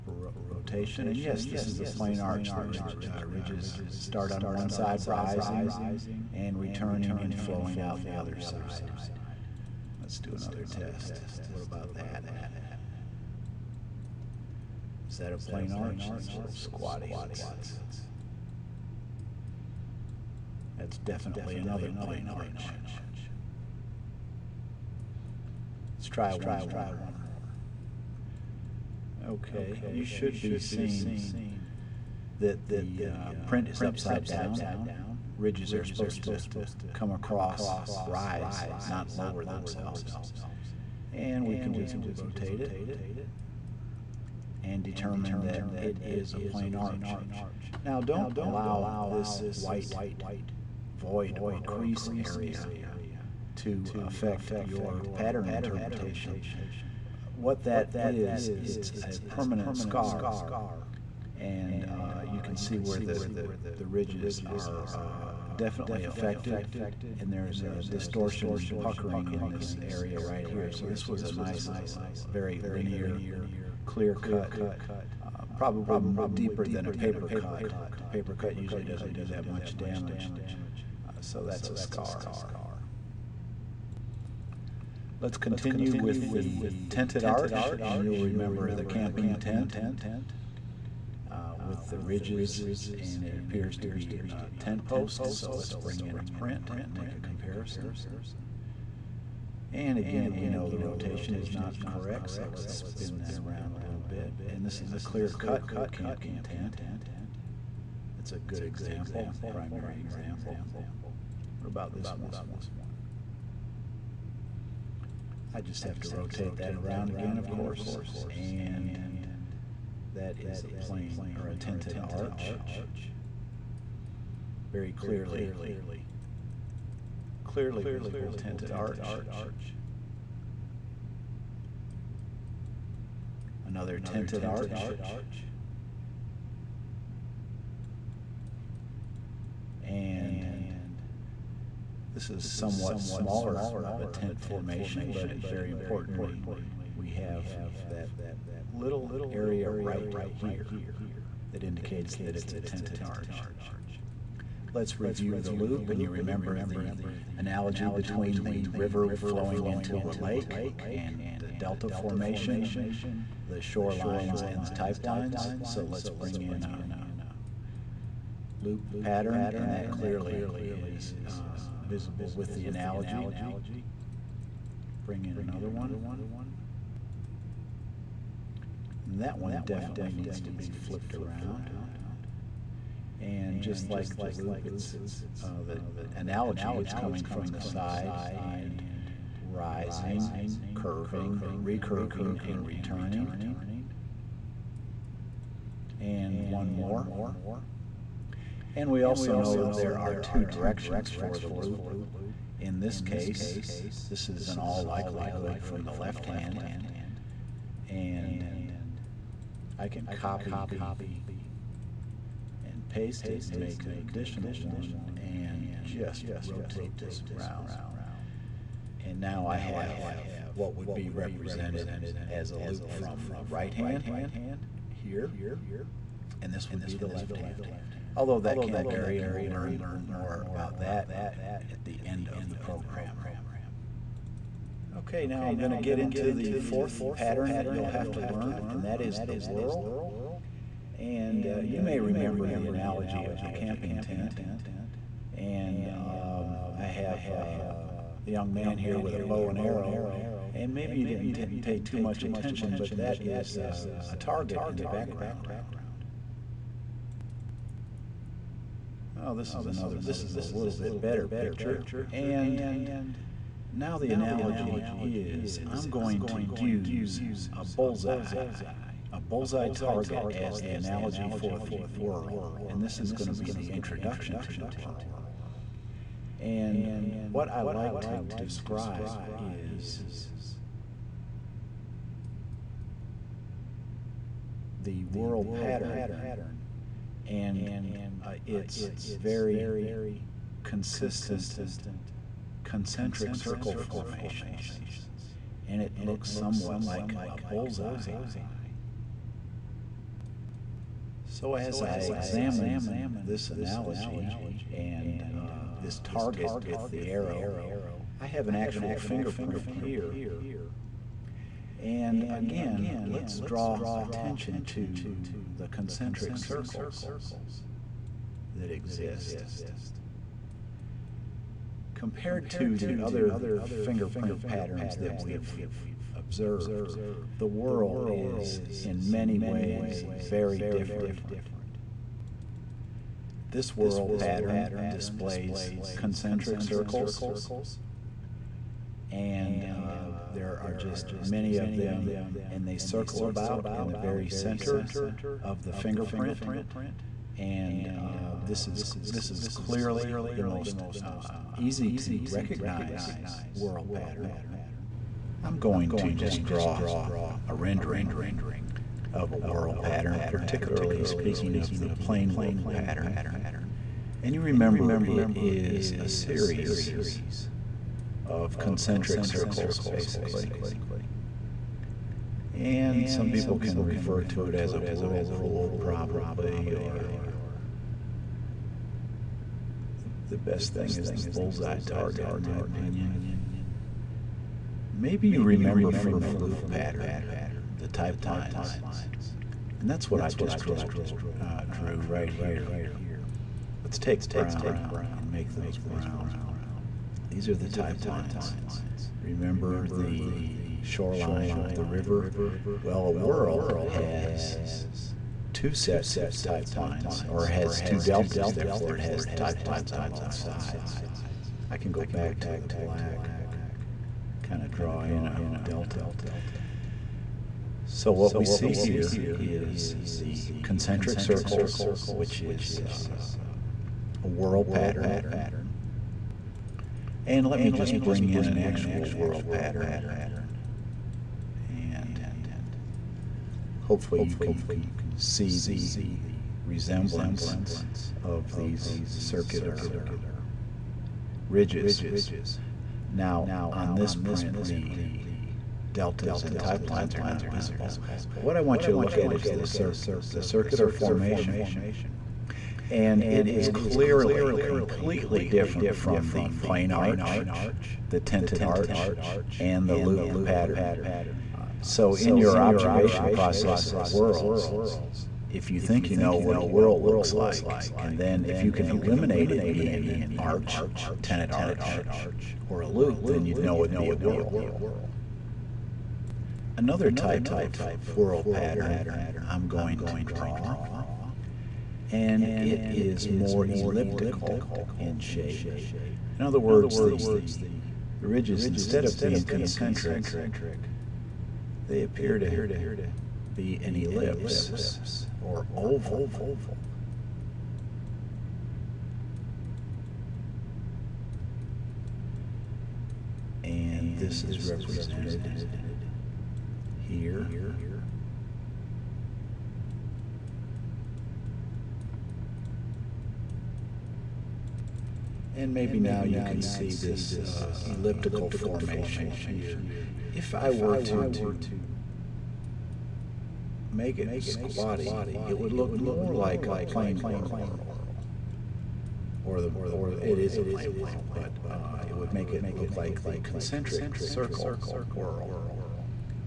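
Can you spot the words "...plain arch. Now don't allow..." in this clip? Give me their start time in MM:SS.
00:46.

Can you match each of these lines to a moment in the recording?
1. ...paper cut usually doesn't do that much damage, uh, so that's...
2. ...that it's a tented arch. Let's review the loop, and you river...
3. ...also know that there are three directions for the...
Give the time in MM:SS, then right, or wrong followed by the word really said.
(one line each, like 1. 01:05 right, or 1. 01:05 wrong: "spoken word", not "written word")
1. 01:18 right
2. 02:32 wrong: "remember", not "river"
3. 03:19 wrong: "two", not "three".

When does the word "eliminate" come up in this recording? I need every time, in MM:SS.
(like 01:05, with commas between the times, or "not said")
07:48.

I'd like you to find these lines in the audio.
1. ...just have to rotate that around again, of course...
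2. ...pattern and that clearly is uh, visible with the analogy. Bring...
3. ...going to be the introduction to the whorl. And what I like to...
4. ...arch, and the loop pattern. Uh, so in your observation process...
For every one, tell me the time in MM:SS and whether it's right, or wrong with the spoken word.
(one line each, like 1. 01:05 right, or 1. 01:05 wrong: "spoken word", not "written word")
1. 01:55 right
2. 02:49 right
3. 04:33 right
4. 07:38 right.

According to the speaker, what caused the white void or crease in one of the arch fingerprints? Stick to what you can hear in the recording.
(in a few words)
A permanent scar.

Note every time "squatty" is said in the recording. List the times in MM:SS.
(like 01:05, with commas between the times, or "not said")
00:16, 08:44.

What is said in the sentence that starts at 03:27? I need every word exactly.
And I can copy and paste it and make an additional one and just rotate this around.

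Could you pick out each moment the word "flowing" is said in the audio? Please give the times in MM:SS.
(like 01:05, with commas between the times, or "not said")
00:07, 02:39.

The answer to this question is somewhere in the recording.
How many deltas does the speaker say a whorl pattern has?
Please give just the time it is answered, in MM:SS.
06:47.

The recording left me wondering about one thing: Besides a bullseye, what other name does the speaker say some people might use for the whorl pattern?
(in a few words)
A whirlpool.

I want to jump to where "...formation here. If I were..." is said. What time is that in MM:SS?
08:38.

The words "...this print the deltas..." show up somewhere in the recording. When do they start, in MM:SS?
07:23.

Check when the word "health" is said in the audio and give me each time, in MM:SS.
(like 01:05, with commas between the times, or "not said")
not said.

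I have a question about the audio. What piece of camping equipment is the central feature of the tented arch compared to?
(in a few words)
A tent post.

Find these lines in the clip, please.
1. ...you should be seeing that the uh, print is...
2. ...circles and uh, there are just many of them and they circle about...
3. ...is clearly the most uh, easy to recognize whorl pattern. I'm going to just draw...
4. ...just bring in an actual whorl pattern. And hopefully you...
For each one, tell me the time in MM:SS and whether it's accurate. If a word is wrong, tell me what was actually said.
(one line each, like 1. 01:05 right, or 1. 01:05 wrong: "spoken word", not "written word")
1. 00:29 right
2. 05:36 right
3. 05:49 right
4. 07:07 right.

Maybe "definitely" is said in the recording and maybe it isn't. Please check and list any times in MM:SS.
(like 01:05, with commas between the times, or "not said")
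00:20, 01:05, 02:59.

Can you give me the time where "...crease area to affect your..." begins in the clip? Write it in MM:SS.
00:51.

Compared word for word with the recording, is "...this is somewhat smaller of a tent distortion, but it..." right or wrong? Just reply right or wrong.
wrong.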